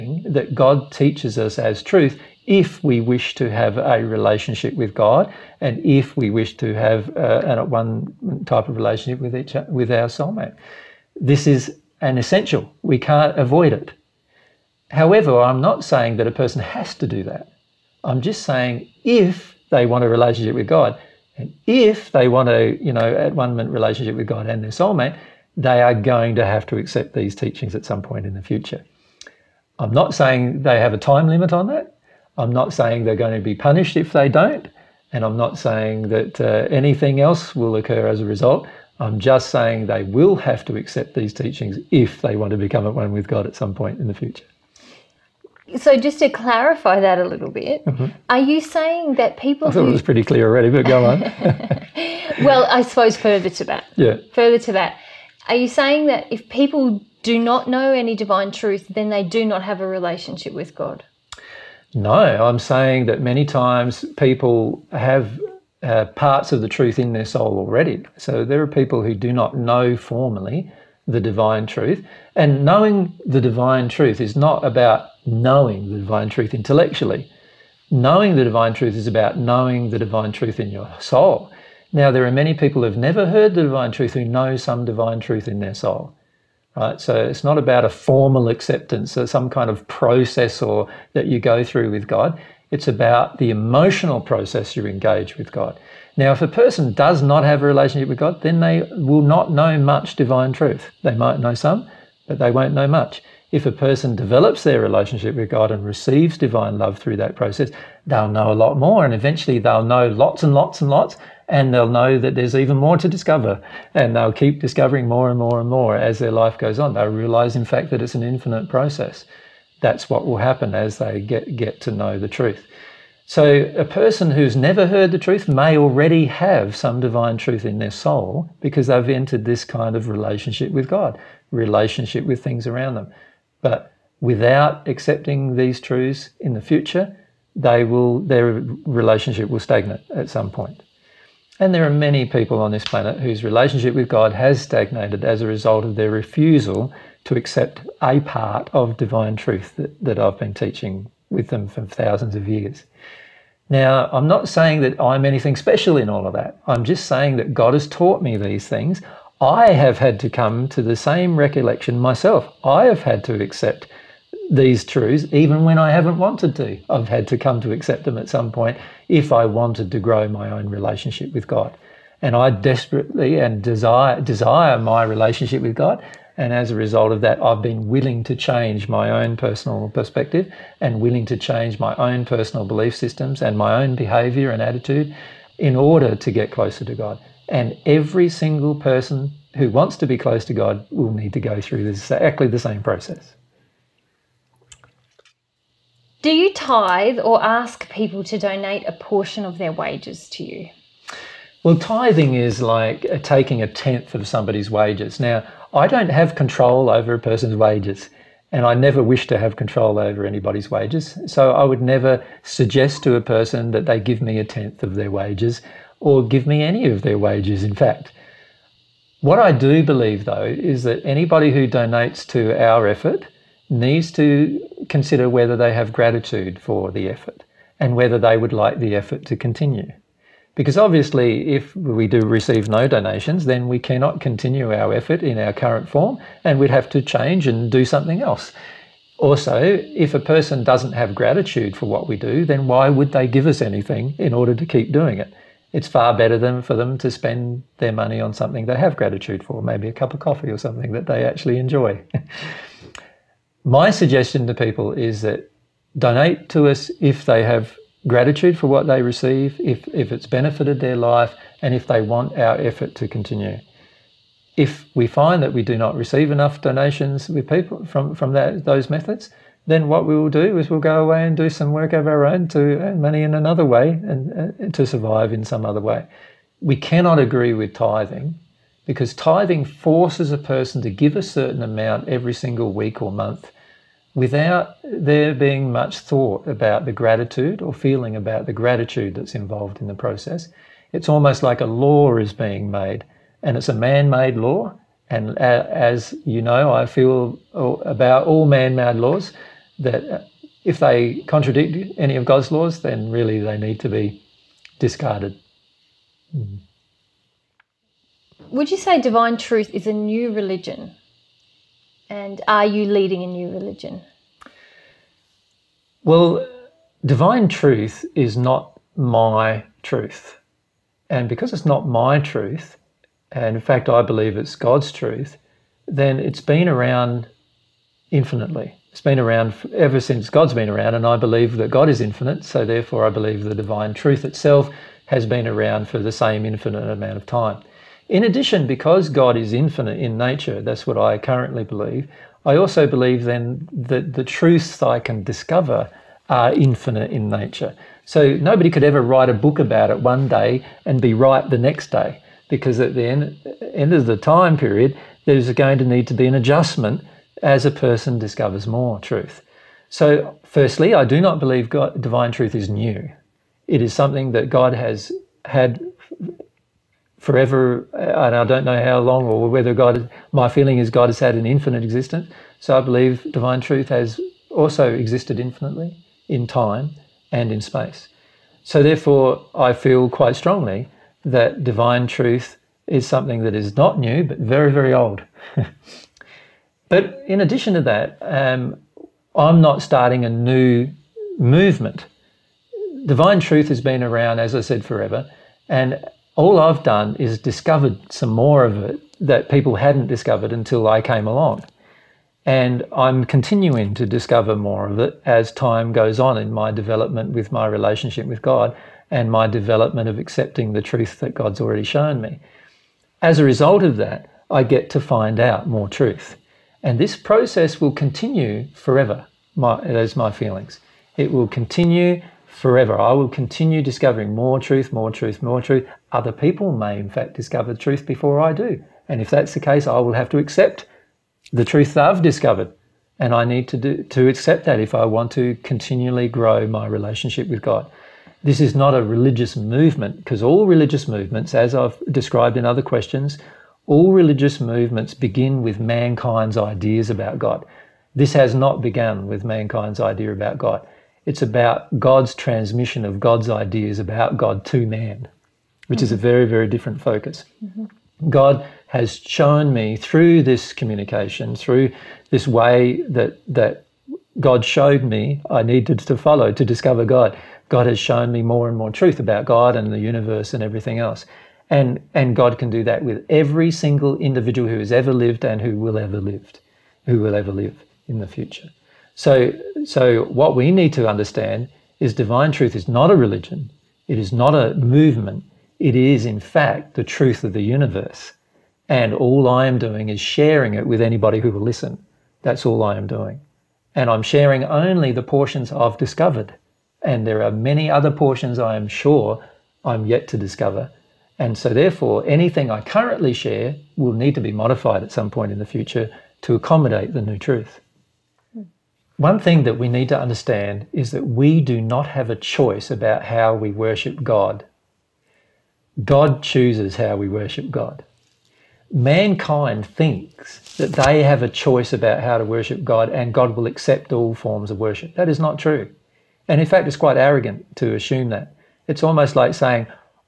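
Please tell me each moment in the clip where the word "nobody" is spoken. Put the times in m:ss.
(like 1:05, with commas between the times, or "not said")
5:48.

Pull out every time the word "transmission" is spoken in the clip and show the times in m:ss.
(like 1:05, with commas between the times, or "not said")
7:32.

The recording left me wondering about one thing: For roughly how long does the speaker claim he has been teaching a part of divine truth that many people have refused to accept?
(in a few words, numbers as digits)
thousands of years.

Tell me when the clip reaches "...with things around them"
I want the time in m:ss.
2:12.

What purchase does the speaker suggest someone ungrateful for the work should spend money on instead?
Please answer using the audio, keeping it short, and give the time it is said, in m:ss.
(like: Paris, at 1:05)
a cup of coffee, at 4:09.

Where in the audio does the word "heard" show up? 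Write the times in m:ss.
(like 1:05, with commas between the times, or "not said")
1:23, 2:04.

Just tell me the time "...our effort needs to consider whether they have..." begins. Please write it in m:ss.
3:42.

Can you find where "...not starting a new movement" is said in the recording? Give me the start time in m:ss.
6:29.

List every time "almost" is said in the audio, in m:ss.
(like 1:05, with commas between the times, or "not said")
4:51, 8:49.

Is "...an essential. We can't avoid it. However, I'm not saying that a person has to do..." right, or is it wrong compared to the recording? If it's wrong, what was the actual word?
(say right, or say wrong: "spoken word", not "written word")
right.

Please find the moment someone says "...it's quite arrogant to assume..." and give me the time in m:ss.
8:46.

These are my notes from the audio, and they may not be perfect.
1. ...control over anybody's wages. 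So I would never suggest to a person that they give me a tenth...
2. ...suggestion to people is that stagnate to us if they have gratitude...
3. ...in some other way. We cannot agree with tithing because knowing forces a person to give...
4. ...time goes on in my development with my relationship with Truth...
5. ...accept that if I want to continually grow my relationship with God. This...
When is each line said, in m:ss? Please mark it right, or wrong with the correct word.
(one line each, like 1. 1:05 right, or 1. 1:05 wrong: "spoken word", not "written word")
1. 3:29 right
2. 4:13 wrong: "donate", not "stagnate"
3. 4:35 wrong: "tithing", not "knowing"
4. 6:45 wrong: "God", not "Truth"
5. 7:14 right.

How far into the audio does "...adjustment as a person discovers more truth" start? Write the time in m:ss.
5:56.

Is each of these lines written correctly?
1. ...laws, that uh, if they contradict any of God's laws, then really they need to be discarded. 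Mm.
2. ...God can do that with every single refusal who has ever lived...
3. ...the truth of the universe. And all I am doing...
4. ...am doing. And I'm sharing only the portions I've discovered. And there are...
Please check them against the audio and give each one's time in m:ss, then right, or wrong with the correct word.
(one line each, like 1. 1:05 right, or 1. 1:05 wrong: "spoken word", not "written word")
1. 4:58 right
2. 7:52 wrong: "individual", not "refusal"
3. 8:06 right
4. 8:12 right.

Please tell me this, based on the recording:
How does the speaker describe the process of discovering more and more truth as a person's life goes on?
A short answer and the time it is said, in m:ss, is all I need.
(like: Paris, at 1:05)
an infinite process, at 1:58.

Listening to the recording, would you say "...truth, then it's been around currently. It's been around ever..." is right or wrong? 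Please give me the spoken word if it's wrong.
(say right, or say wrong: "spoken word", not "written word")
wrong: "infinitely", not "currently".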